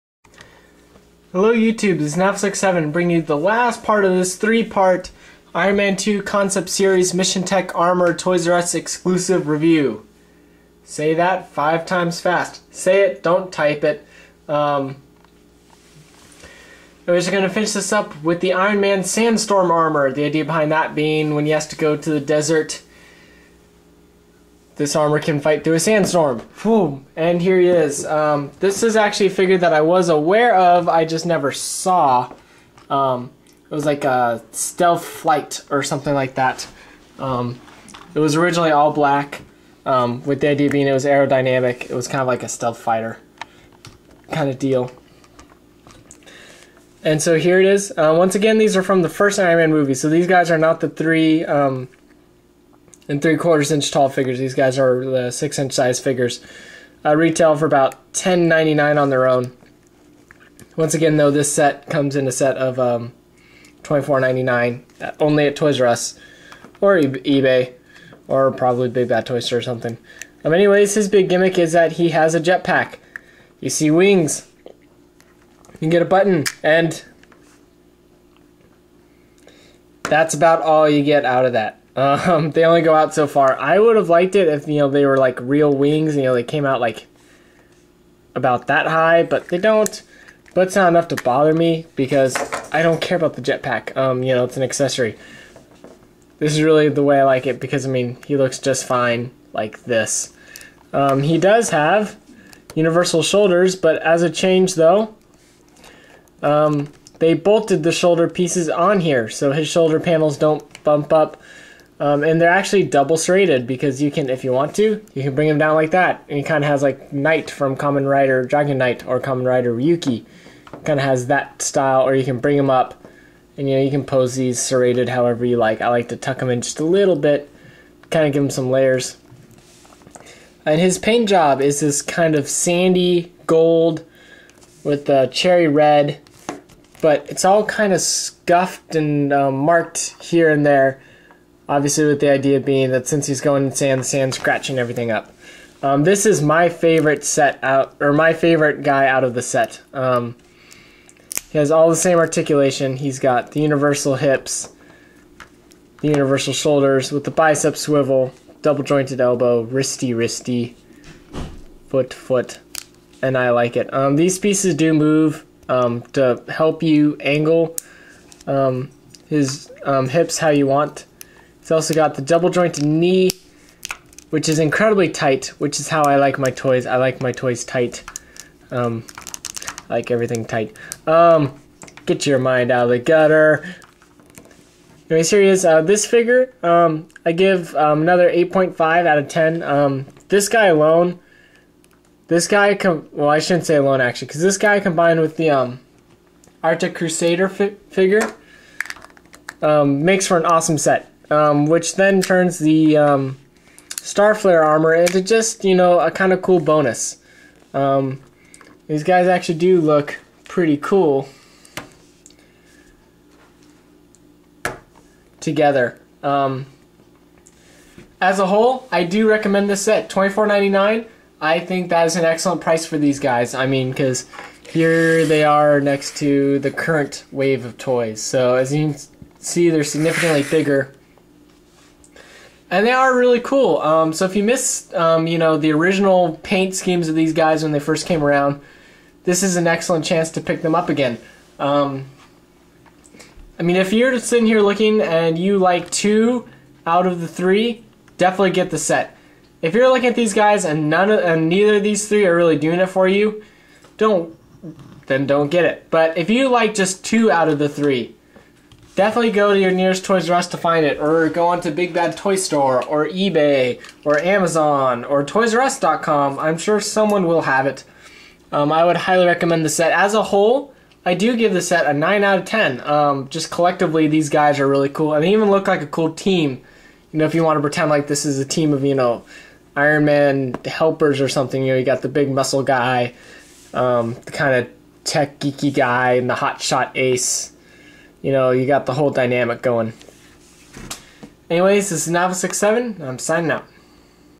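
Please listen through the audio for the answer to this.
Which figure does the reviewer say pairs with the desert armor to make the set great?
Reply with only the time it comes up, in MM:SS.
03:16.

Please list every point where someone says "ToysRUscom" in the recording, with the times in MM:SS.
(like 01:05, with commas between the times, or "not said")
04:25.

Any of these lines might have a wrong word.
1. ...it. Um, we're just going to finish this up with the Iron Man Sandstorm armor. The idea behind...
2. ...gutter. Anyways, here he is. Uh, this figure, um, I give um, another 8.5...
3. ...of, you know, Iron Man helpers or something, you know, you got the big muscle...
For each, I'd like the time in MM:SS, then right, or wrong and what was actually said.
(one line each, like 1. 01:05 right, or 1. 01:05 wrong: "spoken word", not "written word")
1. 00:13 right
2. 03:02 right
3. 04:38 right.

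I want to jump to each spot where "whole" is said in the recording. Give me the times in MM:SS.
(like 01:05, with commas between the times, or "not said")
03:38, 04:30, 04:48.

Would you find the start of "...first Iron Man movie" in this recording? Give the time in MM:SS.
00:49.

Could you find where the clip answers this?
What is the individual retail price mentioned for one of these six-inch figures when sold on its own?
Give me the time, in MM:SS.
00:58.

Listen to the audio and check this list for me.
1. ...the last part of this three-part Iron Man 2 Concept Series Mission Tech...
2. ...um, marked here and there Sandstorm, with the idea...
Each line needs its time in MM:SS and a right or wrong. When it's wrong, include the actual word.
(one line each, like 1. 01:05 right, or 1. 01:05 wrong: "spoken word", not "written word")
1. 00:03 right
2. 02:19 wrong: "Obviously", not "Sandstorm".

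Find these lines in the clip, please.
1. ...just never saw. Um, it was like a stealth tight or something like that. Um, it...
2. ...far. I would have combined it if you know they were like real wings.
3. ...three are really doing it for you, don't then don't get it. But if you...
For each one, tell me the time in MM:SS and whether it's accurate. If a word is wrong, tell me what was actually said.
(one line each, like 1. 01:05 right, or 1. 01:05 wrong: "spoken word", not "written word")
1. 00:31 wrong: "flight", not "tight"
2. 01:23 wrong: "liked", not "combined"
3. 04:12 right.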